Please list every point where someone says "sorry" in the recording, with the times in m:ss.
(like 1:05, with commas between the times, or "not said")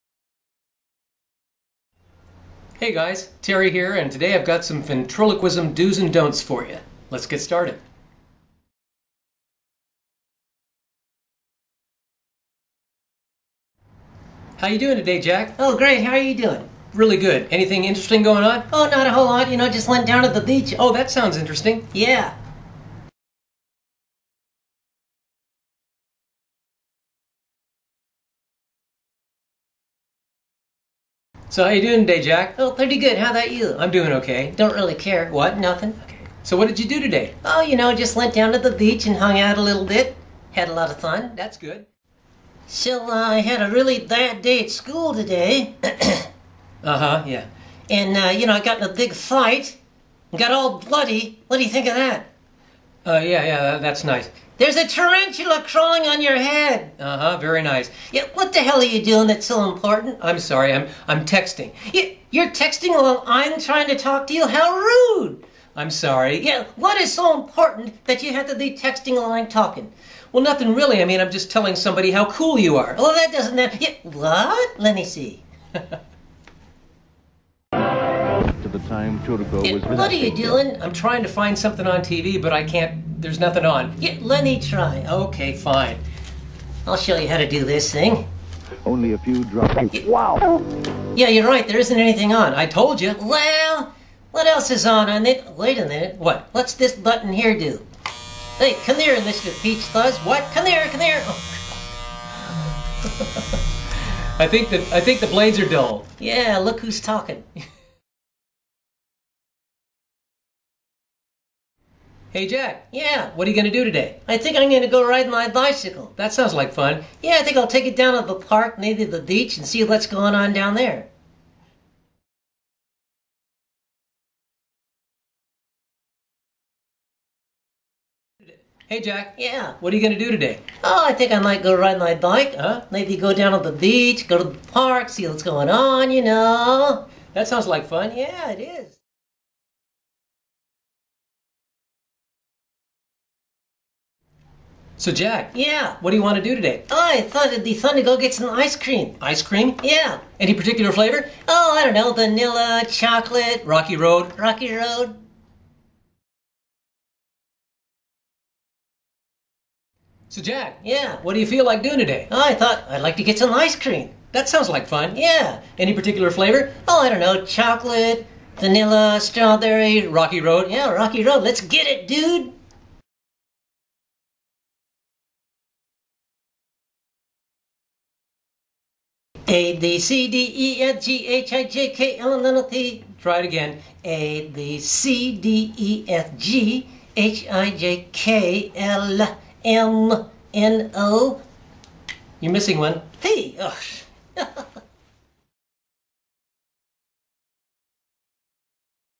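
1:00, 1:05.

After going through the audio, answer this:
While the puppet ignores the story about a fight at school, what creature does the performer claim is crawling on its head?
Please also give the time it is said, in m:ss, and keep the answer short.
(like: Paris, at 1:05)
Tarantula, at 0:54.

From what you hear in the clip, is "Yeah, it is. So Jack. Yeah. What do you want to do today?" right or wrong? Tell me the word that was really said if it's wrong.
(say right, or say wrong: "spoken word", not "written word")
right.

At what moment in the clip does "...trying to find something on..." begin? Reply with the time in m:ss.
1:20.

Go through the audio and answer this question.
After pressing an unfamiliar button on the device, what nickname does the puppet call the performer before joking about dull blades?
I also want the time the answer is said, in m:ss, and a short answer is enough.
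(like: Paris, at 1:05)
Mr. Peach Fuzz, at 1:39.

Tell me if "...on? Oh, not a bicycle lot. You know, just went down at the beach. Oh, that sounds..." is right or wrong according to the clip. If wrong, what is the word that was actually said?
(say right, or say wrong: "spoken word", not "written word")
wrong: "whole", not "bicycle".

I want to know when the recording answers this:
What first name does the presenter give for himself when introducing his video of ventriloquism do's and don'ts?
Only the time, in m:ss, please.
0:03.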